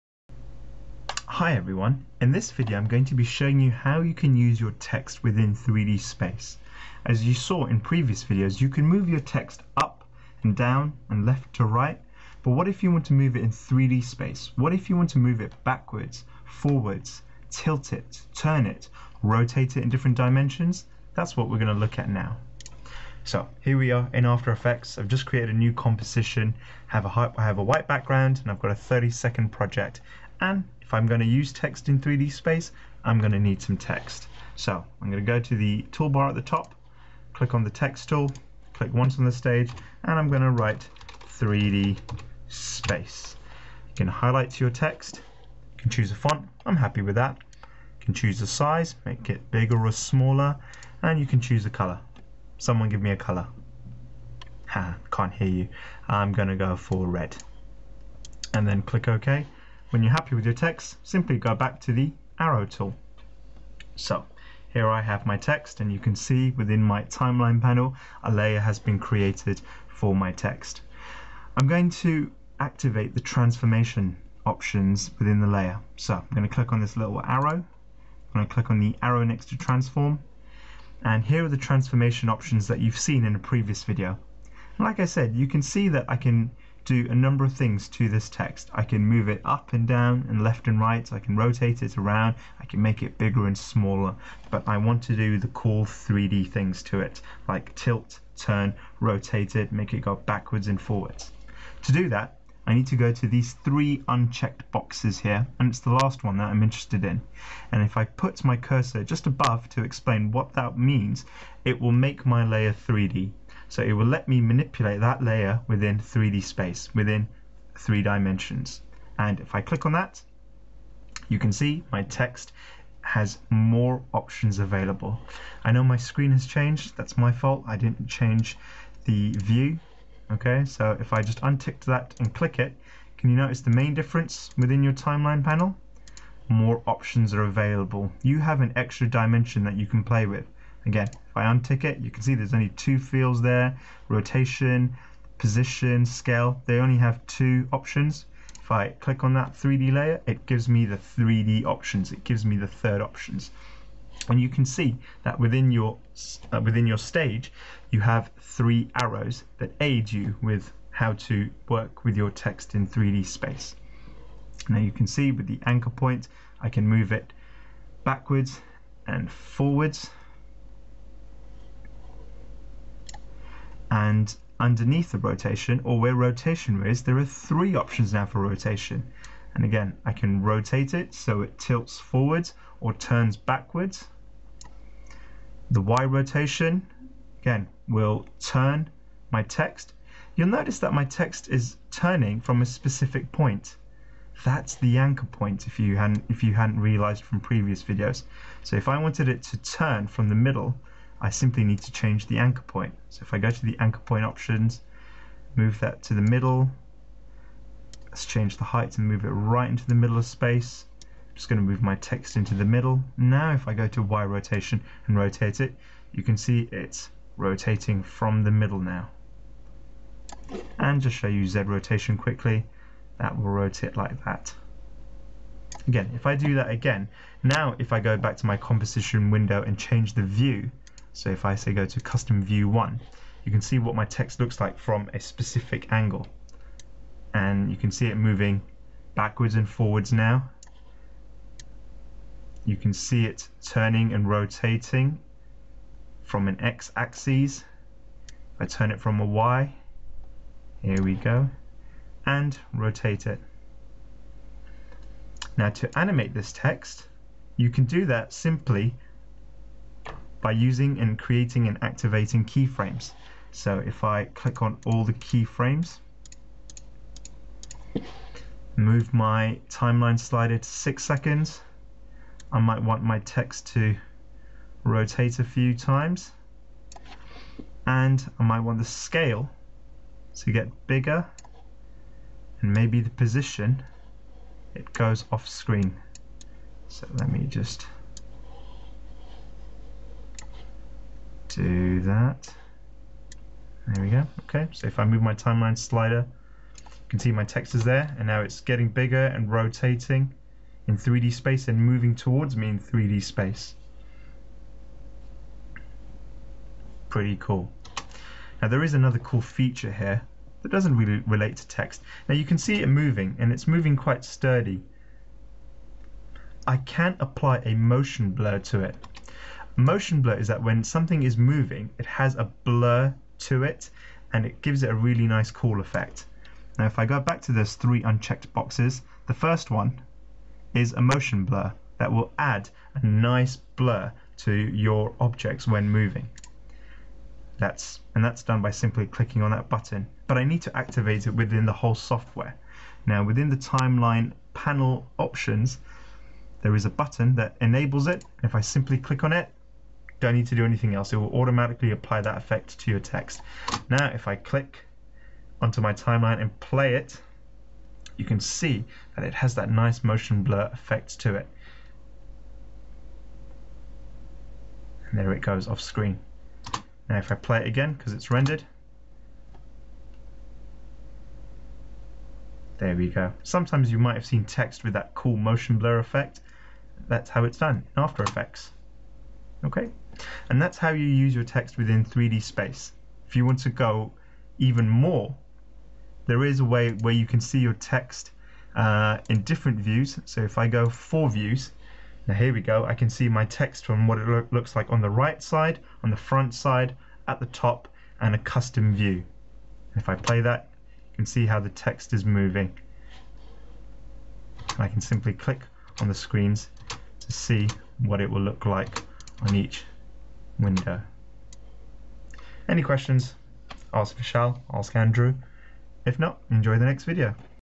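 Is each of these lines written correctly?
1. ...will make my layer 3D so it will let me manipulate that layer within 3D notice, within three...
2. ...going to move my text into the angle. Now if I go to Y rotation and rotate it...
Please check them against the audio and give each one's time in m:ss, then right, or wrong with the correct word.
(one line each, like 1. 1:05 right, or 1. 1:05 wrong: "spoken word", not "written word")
1. 1:51 wrong: "space", not "notice"
2. 3:31 wrong: "middle", not "angle".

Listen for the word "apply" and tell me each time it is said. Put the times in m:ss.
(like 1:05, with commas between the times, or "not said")
5:17, 5:51.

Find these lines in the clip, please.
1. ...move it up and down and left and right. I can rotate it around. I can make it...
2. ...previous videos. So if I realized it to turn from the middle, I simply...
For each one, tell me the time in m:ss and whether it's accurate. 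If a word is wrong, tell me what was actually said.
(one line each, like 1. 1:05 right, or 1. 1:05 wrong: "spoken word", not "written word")
1. 1:29 right
2. 3:17 wrong: "wanted", not "realized".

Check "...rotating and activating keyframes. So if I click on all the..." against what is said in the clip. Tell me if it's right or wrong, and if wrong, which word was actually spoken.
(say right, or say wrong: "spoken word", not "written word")
wrong: "creating", not "rotating".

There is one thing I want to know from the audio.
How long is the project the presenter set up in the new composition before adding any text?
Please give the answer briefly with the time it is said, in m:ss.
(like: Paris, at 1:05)
30 seconds, at 0:28.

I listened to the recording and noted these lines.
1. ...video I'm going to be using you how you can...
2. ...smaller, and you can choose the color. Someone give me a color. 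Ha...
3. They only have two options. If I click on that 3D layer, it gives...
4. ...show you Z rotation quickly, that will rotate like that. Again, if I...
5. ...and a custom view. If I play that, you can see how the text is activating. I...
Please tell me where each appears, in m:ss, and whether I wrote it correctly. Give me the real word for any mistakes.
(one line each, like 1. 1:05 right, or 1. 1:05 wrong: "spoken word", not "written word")
1. 0:02 wrong: "showing", not "using"
2. 0:49 right
3. 2:26 right
4. 3:41 right
5. 6:38 wrong: "moving", not "activating".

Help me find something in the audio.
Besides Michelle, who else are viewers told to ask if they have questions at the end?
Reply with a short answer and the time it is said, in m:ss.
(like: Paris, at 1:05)
Andrew, at 6:54.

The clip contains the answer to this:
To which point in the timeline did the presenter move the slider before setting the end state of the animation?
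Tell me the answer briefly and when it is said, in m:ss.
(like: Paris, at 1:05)
6 seconds, at 4:30.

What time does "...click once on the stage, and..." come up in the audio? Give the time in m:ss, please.
0:38.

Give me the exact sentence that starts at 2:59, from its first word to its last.
And again, I can rotate it so it tilts forward or turns backwards.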